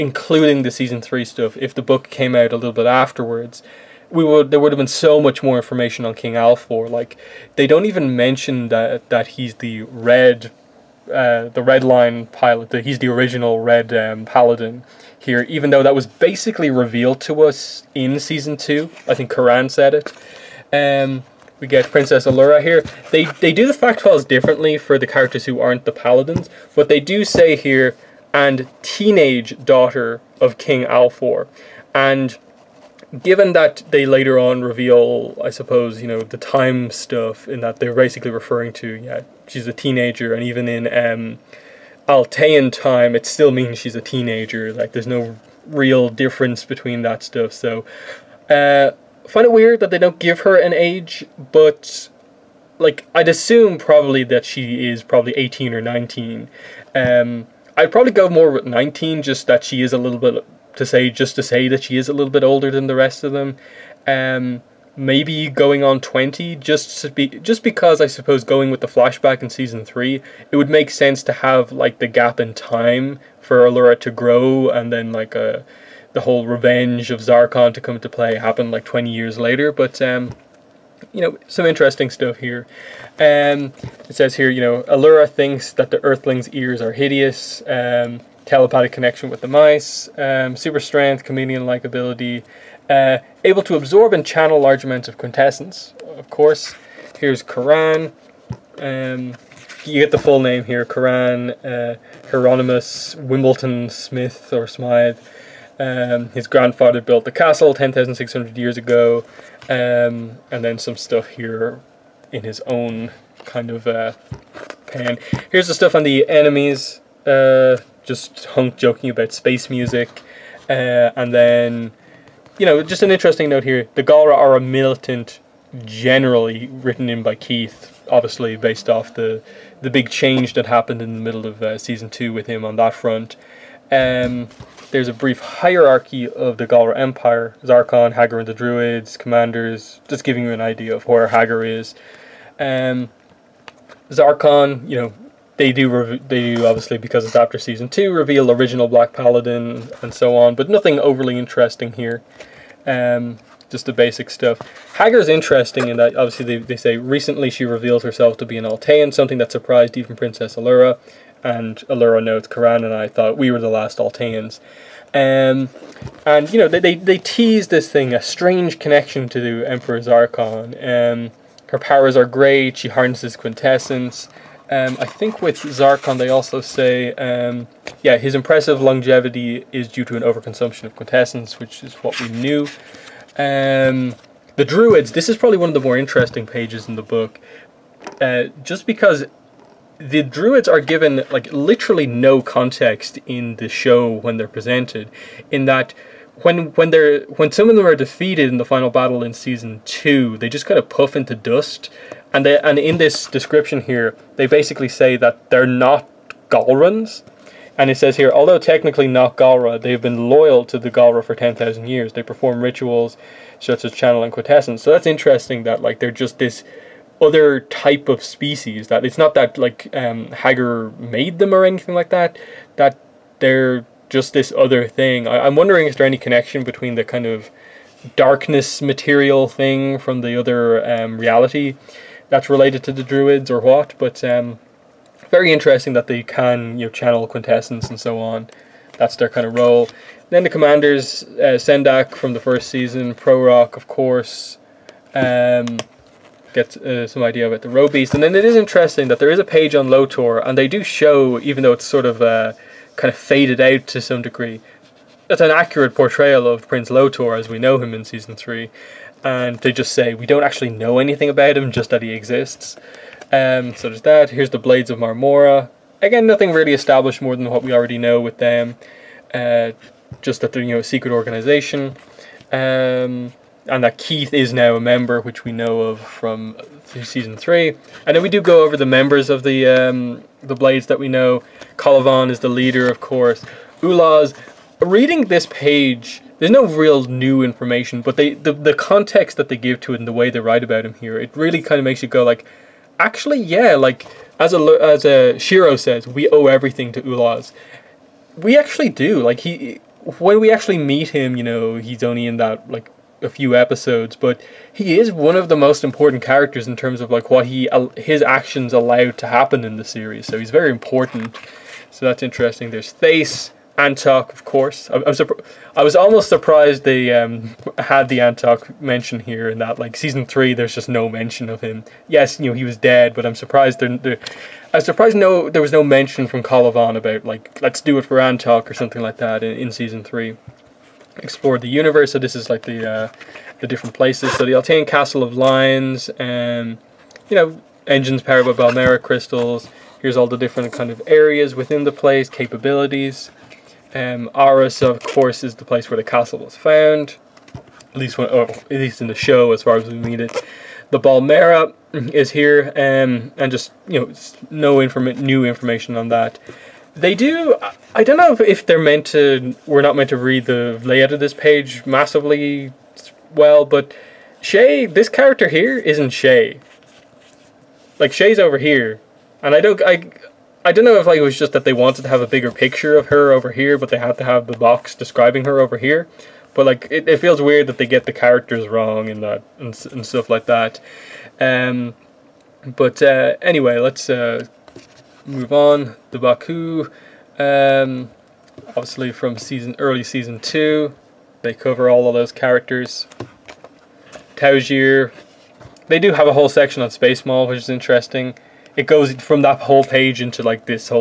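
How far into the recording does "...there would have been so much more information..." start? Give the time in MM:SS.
00:04.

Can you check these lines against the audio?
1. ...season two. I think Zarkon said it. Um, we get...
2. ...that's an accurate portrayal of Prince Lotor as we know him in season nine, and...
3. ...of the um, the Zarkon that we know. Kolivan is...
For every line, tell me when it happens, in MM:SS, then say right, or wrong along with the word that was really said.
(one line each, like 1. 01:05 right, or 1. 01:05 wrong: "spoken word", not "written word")
1. 00:18 wrong: "Coran", not "Zarkon"
2. 04:15 wrong: "three", not "nine"
3. 04:39 wrong: "Blades", not "Zarkon".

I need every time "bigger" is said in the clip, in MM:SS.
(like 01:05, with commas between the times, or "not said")
06:12.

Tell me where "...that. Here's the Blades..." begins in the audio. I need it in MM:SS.
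04:24.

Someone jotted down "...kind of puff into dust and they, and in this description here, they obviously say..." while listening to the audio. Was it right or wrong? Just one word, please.
wrong.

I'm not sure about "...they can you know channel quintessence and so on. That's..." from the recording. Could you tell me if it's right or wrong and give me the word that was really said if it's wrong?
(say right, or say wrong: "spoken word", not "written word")
right.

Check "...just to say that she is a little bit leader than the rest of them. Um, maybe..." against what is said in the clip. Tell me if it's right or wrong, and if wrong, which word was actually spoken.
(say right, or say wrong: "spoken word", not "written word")
wrong: "older", not "leader".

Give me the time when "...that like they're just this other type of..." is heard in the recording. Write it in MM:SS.
03:35.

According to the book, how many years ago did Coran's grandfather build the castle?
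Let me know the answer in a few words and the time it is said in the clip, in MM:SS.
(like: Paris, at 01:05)
10,600 years, at 01:47.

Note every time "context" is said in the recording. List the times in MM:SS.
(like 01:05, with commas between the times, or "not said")
03:12, 04:48.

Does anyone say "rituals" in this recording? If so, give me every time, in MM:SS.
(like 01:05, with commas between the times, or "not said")
03:32.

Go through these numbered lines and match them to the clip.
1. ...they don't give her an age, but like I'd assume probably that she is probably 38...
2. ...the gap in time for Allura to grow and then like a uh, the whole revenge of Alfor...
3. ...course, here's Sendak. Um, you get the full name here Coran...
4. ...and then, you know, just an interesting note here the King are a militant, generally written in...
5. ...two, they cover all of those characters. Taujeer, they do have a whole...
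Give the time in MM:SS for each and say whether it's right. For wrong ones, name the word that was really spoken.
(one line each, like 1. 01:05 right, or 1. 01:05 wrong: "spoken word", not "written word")
1. 00:49 wrong: "18", not "38"
2. 01:11 wrong: "Zarkon", not "Alfor"
3. 01:36 wrong: "Coran", not "Sendak"
4. 02:01 wrong: "Galra", not "King"
5. 06:30 right.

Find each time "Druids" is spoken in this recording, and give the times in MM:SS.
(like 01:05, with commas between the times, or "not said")
02:18, 03:04, 03:10, 03:53.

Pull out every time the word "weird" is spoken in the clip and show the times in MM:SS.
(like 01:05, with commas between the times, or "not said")
00:49, 06:17.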